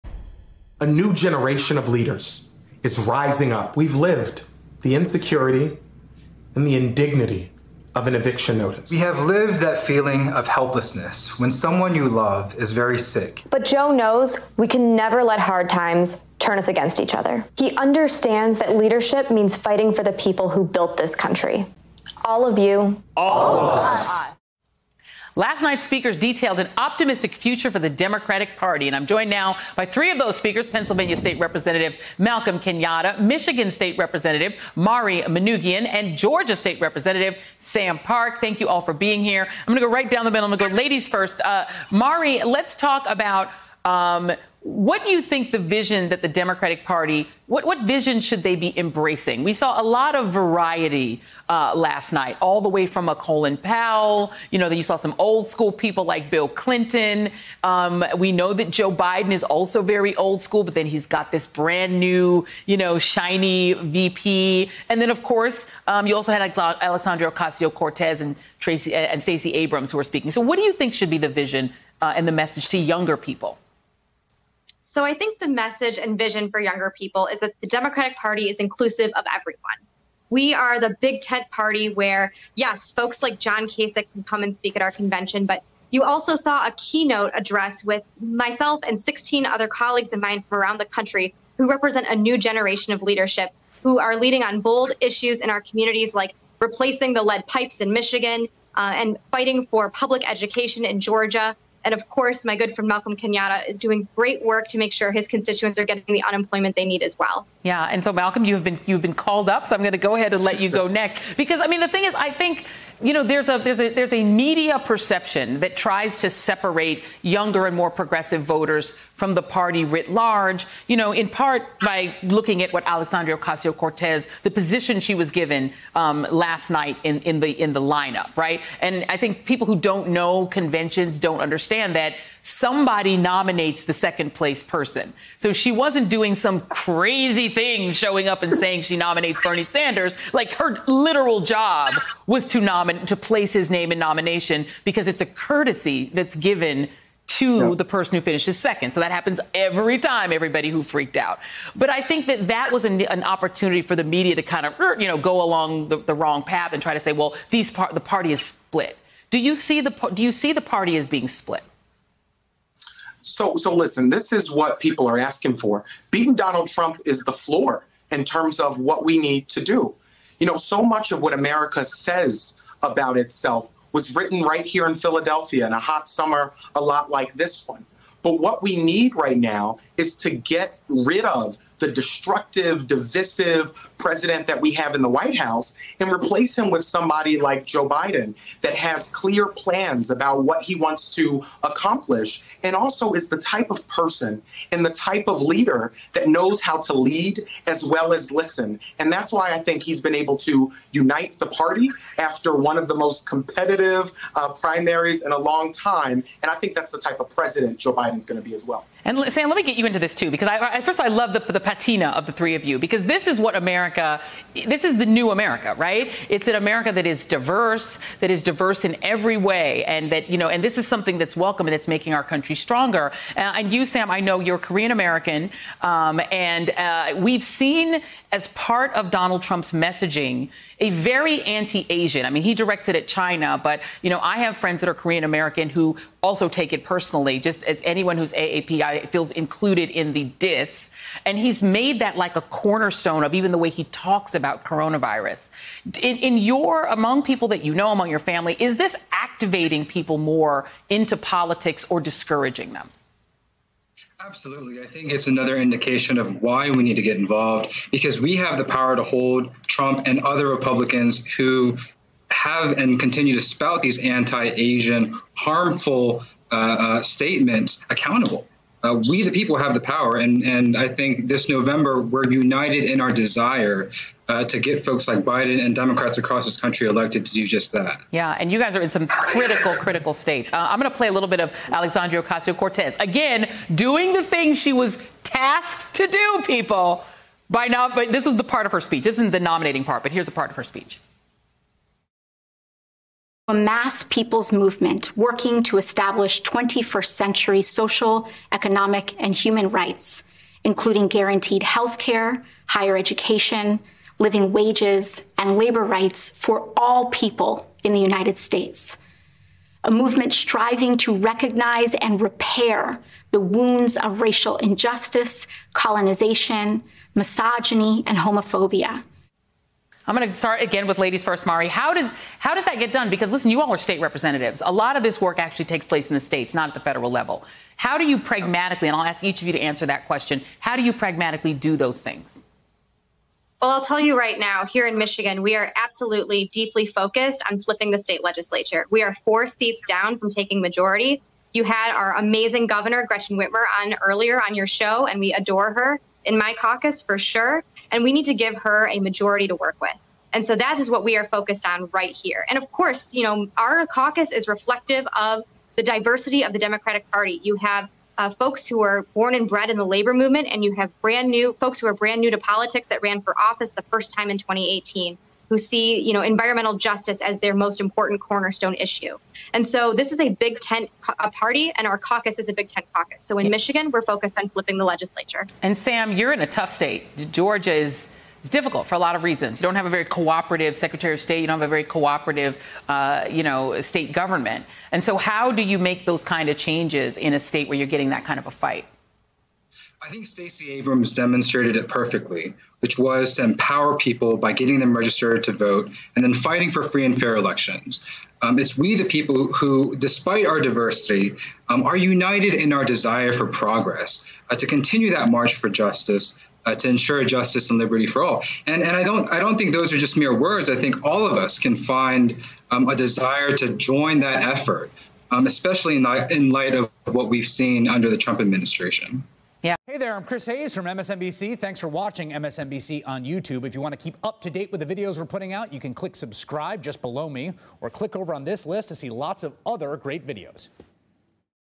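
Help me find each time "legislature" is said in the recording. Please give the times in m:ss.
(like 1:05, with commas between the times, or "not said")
5:38, 6:14.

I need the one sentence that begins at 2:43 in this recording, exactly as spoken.
So so listen, this is what people are asking for.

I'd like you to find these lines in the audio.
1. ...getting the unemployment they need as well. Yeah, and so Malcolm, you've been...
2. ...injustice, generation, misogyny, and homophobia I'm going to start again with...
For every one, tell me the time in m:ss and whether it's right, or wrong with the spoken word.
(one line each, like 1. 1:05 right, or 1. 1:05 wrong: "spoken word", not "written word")
1. 1:45 right
2. 5:14 wrong: "colonization", not "generation".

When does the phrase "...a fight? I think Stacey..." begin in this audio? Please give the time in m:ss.
6:28.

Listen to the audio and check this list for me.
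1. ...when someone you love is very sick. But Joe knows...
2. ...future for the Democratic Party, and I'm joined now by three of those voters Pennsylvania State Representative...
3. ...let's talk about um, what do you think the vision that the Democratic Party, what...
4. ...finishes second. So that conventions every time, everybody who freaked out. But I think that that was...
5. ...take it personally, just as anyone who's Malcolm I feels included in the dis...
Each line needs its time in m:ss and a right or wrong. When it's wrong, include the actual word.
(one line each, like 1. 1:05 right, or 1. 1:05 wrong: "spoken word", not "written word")
1. 0:11 right
2. 0:27 wrong: "speakers", not "voters"
3. 0:42 right
4. 2:28 wrong: "happens", not "conventions"
5. 3:56 wrong: "AAPI", not "Malcolm".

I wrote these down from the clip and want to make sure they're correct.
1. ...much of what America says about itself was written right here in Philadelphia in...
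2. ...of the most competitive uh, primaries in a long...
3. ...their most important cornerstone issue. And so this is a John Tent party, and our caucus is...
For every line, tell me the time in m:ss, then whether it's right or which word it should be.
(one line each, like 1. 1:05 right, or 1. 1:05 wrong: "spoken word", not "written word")
1. 2:50 right
2. 3:22 right
3. 6:07 wrong: "Big", not "John".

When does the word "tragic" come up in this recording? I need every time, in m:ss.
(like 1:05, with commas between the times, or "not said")
not said.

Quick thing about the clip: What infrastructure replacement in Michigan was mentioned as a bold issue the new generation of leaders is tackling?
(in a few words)
lead pipes.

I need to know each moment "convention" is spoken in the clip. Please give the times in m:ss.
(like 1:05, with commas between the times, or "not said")
1:24, 2:10.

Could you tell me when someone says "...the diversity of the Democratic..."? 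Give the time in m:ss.
5:55.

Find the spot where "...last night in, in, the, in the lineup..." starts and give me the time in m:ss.
2:06.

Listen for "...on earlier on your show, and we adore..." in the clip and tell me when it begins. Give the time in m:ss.
5:43.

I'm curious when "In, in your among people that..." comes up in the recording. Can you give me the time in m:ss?
4:06.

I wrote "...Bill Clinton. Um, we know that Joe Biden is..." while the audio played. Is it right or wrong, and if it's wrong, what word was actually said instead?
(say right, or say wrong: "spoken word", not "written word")
right.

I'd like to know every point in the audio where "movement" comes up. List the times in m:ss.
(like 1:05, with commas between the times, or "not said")
4:54, 5:09, 6:00.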